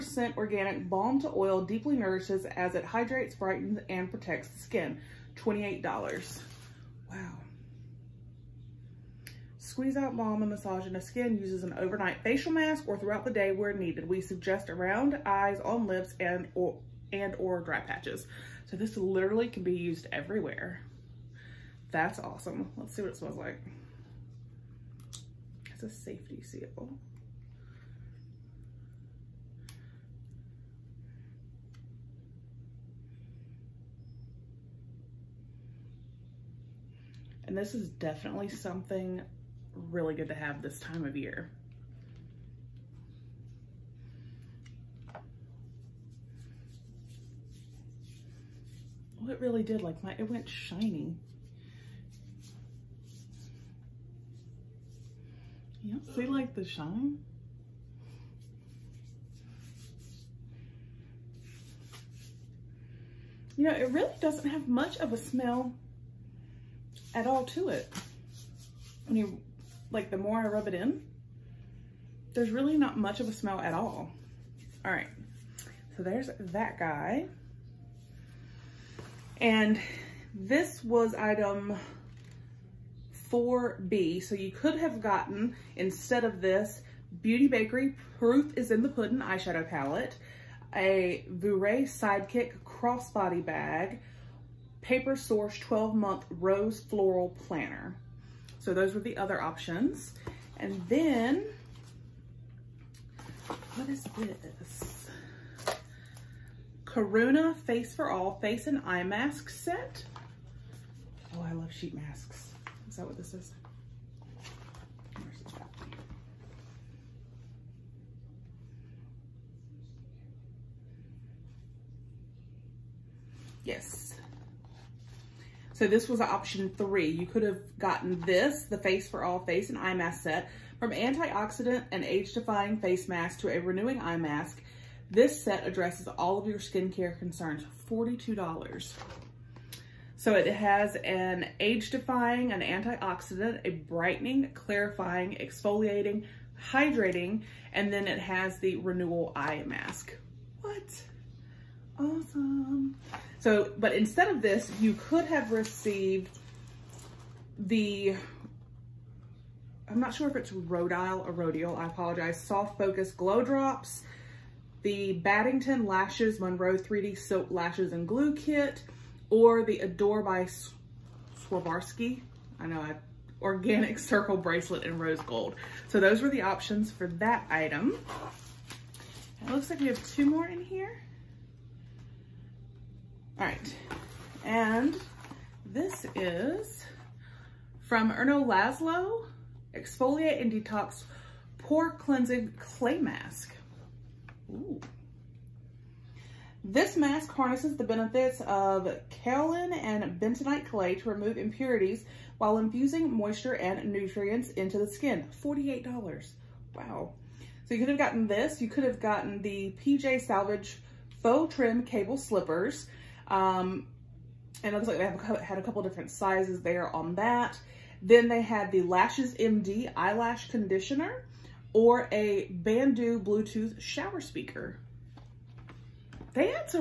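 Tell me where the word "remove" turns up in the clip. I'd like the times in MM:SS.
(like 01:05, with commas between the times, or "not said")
03:21.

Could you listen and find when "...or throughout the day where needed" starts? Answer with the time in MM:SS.
00:12.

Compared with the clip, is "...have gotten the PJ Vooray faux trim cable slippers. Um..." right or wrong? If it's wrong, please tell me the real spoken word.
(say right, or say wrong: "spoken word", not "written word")
wrong: "Salvage", not "Vooray".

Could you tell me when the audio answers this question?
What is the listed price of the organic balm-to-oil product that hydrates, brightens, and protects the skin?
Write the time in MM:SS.
00:05.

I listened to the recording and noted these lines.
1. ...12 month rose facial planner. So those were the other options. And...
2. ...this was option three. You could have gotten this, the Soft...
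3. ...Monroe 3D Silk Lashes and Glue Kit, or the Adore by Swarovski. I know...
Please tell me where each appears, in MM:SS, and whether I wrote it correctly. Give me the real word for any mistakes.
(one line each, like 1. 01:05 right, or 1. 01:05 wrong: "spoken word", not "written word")
1. 01:35 wrong: "floral", not "facial"
2. 02:05 wrong: "Face", not "Soft"
3. 02:46 right.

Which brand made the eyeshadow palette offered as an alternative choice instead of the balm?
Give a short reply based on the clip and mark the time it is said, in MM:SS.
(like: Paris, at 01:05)
Beauty Bakery, at 01:27.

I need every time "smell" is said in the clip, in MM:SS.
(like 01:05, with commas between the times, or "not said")
00:23, 01:05, 01:13.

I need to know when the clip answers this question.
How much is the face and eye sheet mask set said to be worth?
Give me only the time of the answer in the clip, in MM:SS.
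02:17.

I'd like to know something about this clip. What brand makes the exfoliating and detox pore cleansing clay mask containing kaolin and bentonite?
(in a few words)
Erno Laszlo.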